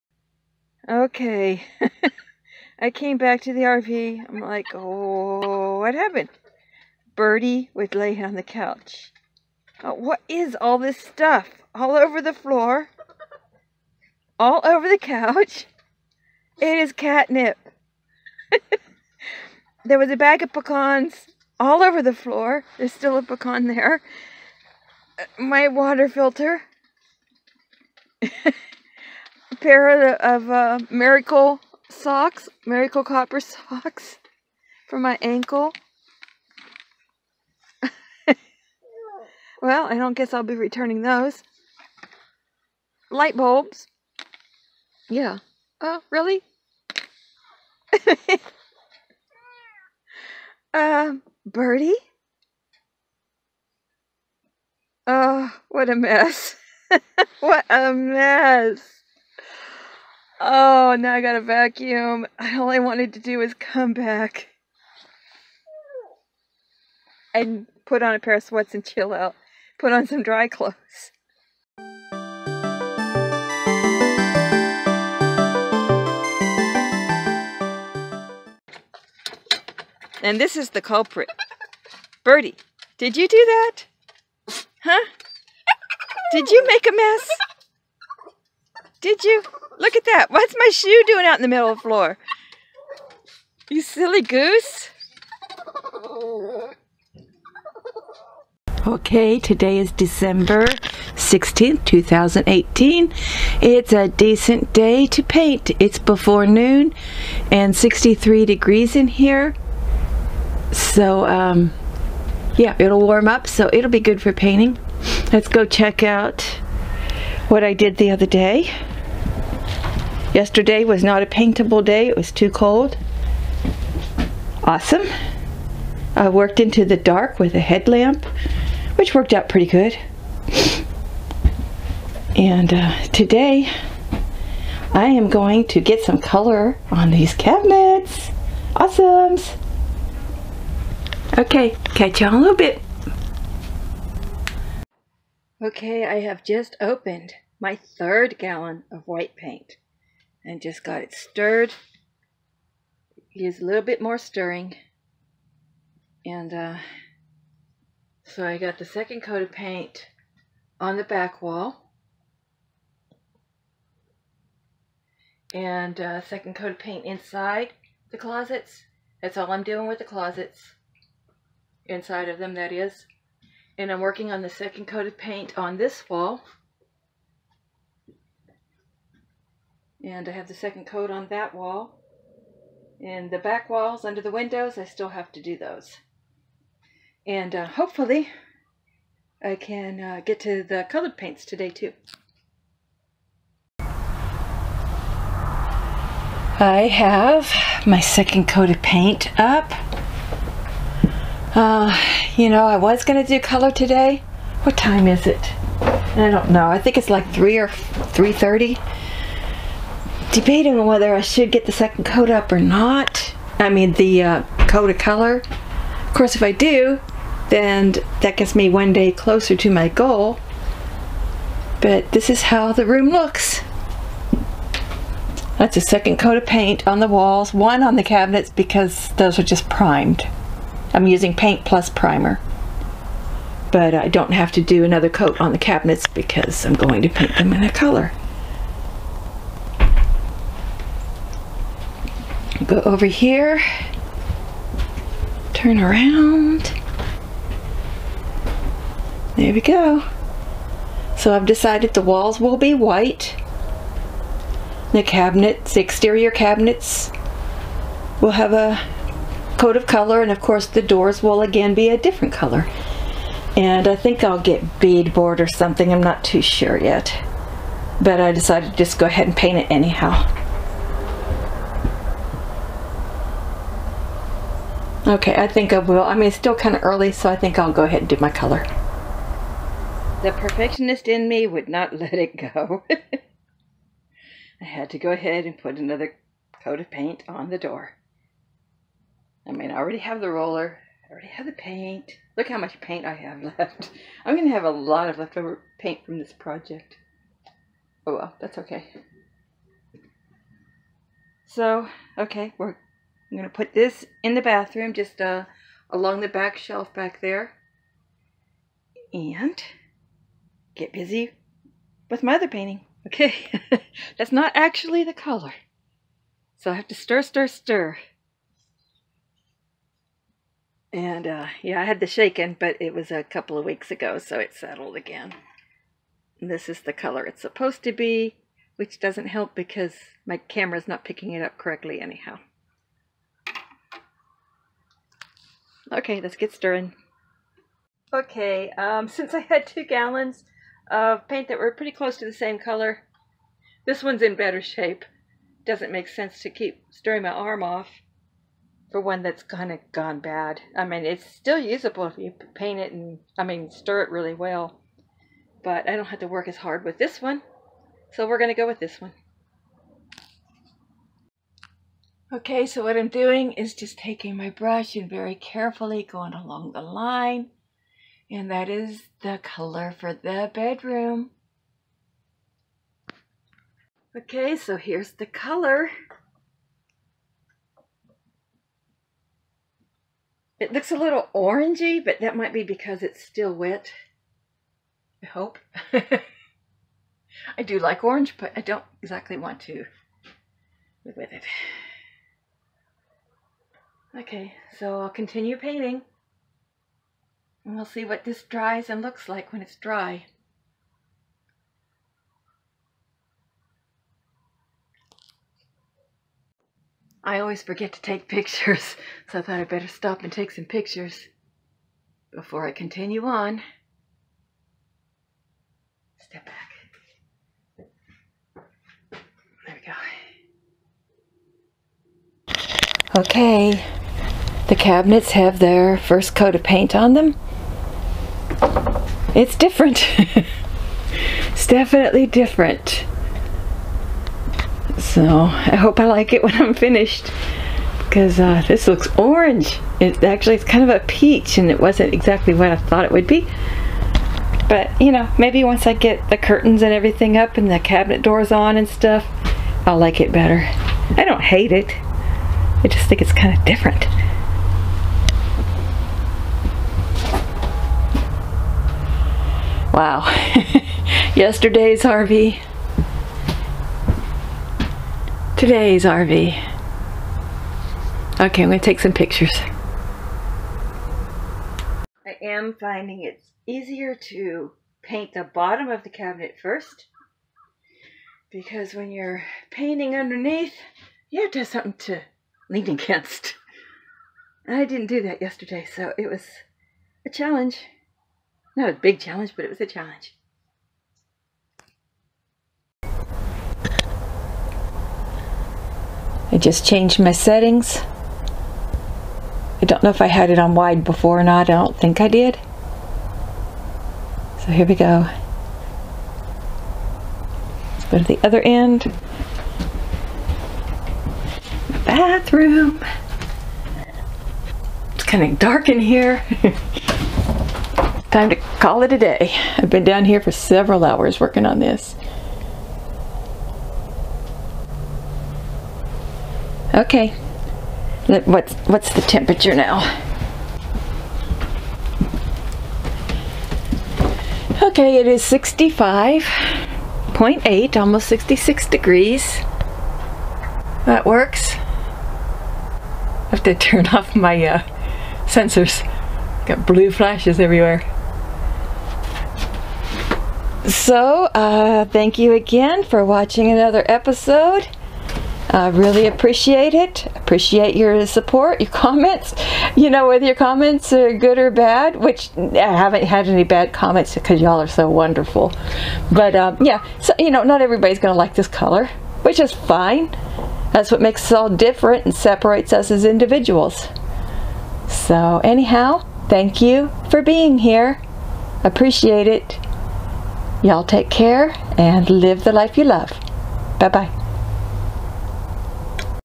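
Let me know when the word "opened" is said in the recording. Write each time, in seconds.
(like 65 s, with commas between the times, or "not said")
146 s.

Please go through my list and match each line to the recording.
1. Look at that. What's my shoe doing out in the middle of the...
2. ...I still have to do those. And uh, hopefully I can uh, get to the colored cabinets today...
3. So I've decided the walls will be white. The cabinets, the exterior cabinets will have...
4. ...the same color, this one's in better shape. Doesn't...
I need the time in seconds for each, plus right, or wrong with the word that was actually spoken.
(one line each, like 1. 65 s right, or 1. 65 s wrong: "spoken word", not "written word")
1. 89 s right
2. 184 s wrong: "paints", not "cabinets"
3. 251 s right
4. 342 s right.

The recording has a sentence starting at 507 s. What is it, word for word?
Let's go to the other end.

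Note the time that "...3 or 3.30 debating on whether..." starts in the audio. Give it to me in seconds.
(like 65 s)
207 s.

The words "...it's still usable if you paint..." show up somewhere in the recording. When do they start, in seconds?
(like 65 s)
351 s.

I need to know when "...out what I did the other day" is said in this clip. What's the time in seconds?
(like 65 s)
116 s.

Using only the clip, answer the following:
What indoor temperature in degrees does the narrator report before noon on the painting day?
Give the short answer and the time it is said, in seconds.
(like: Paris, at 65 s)
63, at 107 s.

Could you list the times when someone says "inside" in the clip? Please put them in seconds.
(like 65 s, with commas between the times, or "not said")
167 s, 171 s.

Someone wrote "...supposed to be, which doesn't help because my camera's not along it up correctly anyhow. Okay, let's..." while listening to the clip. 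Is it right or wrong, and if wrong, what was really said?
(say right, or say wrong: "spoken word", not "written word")
wrong: "picking", not "along".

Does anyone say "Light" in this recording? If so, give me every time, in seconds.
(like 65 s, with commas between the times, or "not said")
43 s.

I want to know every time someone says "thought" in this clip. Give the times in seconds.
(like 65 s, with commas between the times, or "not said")
409 s, 442 s.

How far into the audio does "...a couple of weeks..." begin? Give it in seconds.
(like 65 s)
323 s.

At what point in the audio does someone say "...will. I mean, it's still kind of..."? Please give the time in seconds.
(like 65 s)
275 s.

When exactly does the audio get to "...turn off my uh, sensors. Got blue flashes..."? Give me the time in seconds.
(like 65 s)
543 s.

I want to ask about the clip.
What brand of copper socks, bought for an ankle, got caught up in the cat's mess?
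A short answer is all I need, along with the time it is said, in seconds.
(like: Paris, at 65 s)
Miracle Copper, at 32 s.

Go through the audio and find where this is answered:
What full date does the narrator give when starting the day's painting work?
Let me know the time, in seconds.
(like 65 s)
99 s.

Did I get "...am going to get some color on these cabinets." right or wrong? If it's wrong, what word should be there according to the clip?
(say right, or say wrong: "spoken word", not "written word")
right.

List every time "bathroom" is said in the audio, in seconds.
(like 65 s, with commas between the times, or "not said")
304 s, 512 s.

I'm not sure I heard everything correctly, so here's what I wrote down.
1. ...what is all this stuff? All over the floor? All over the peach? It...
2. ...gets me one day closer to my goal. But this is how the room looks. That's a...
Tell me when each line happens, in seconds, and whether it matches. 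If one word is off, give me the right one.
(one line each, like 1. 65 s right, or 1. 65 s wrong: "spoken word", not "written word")
1. 9 s wrong: "couch", not "peach"
2. 218 s right.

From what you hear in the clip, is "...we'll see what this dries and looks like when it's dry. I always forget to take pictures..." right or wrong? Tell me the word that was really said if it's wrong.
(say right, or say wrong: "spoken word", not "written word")
right.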